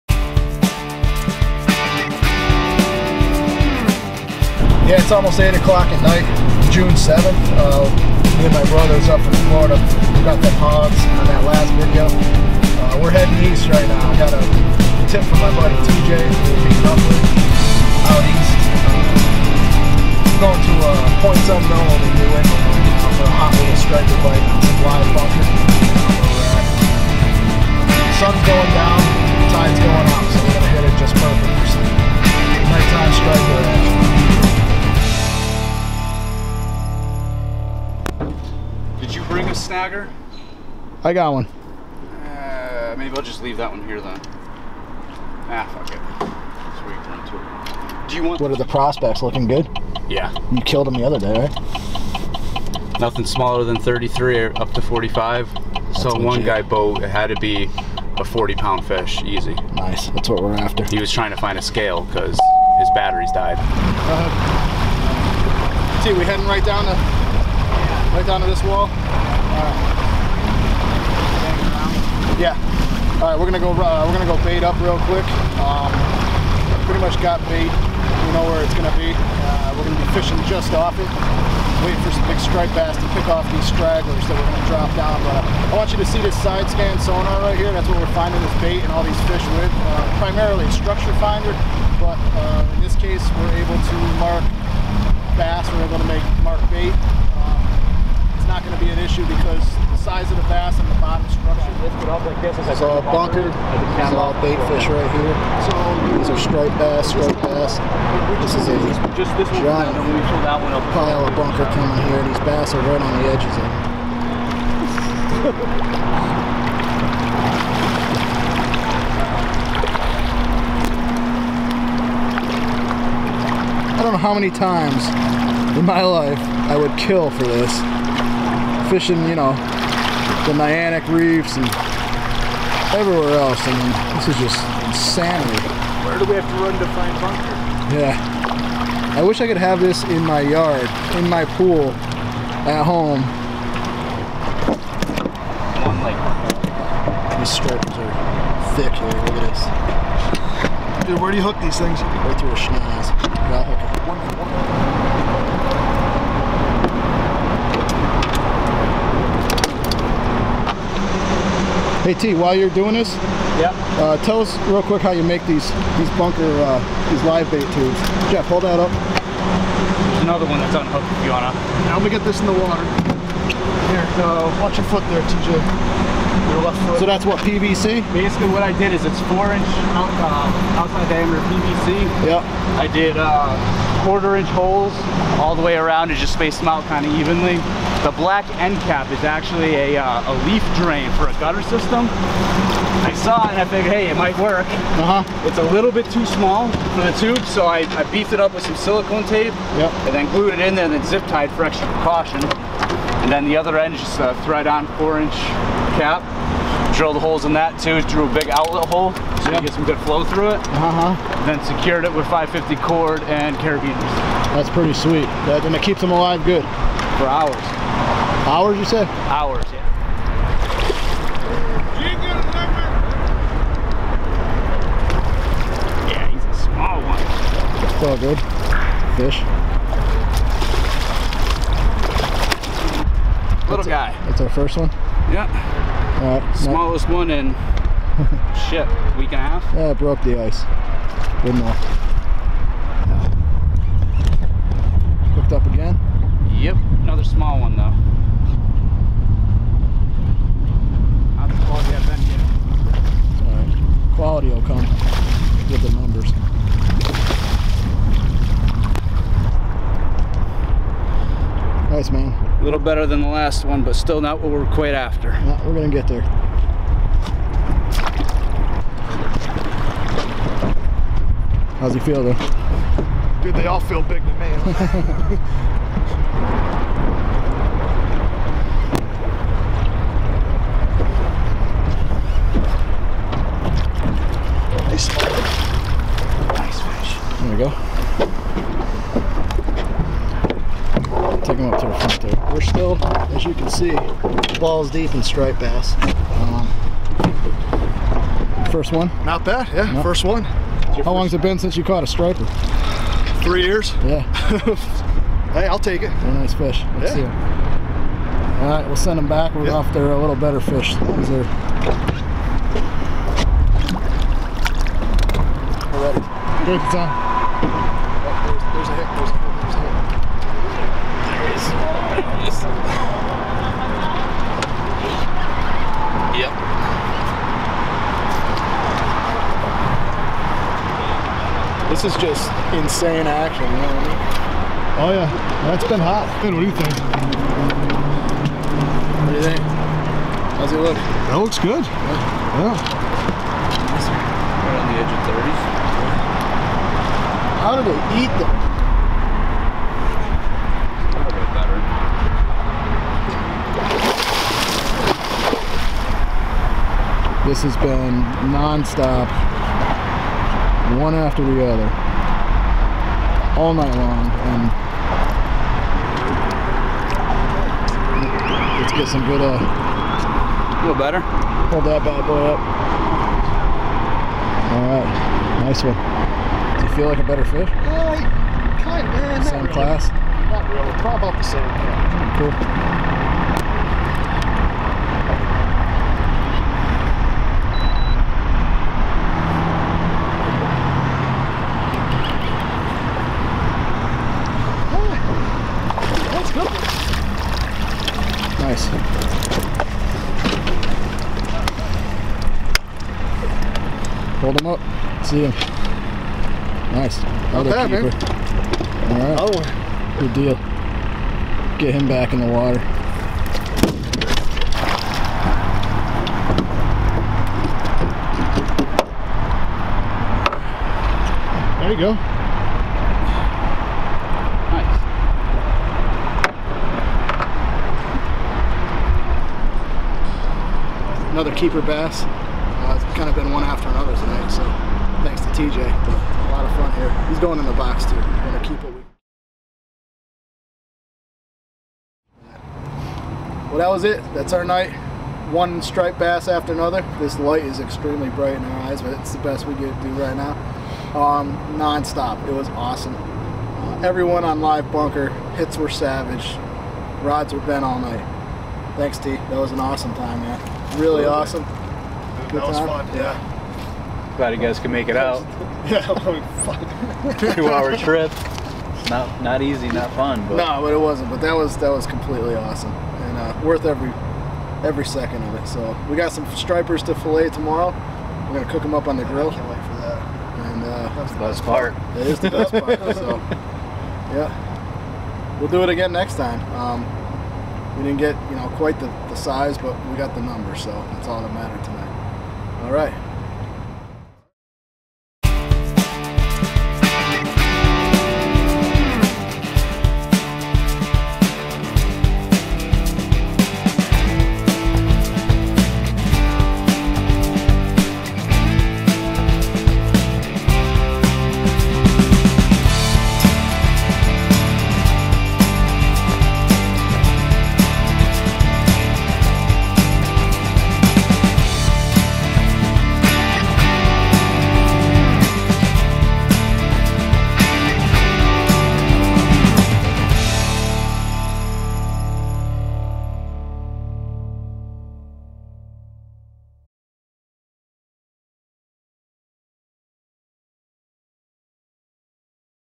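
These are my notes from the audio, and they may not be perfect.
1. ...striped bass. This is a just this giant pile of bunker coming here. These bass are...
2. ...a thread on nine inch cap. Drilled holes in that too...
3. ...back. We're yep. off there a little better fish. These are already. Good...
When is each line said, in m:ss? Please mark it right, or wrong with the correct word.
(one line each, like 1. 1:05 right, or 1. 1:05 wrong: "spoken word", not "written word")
1. 1:47 right
2. 3:24 wrong: "four", not "nine"
3. 5:09 right.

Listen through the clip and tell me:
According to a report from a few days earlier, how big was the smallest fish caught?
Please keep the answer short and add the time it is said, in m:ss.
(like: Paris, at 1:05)
33, at 0:53.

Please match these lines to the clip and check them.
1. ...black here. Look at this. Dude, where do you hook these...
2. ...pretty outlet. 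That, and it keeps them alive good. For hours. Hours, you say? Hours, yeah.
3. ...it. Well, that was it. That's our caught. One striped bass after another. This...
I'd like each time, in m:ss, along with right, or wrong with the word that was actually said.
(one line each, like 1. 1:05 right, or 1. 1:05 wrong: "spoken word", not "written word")
1. 2:28 wrong: "thick", not "black"
2. 3:34 wrong: "sweet", not "outlet"
3. 7:18 wrong: "night", not "caught".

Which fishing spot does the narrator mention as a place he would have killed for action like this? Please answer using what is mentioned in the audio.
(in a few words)
Niantic reefs.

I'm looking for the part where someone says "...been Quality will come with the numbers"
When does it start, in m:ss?
4:12.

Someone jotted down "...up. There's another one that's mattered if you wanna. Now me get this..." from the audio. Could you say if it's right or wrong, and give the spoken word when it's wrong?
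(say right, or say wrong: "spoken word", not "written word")
wrong: "unhooked", not "mattered".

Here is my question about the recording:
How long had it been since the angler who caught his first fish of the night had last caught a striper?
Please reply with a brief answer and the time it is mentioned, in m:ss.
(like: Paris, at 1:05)
3 years, at 5:03.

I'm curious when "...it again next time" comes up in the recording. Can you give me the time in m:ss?
8:05.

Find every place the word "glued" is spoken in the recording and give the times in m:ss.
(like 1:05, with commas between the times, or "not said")
3:20.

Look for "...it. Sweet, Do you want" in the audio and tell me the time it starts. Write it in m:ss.
0:45.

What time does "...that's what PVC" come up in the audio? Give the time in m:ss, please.
2:57.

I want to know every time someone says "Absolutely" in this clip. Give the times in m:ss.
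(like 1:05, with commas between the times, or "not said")
7:41.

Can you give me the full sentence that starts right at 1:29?
Uh, primarily structure finder, but uh, in this case, we're able to mark bass.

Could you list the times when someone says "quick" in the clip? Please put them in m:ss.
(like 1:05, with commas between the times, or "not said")
1:15, 2:44.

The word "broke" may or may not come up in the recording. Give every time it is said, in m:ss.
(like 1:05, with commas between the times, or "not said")
3:59.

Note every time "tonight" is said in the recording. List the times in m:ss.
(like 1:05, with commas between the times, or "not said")
7:14, 8:11.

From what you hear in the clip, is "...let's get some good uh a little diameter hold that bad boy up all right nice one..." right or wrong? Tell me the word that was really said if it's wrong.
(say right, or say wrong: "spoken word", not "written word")
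wrong: "better", not "diameter".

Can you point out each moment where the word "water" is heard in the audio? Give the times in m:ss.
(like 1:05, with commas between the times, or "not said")
2:52, 6:52.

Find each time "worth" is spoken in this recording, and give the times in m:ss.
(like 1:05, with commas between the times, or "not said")
7:53.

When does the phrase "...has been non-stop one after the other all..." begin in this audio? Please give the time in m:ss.
5:57.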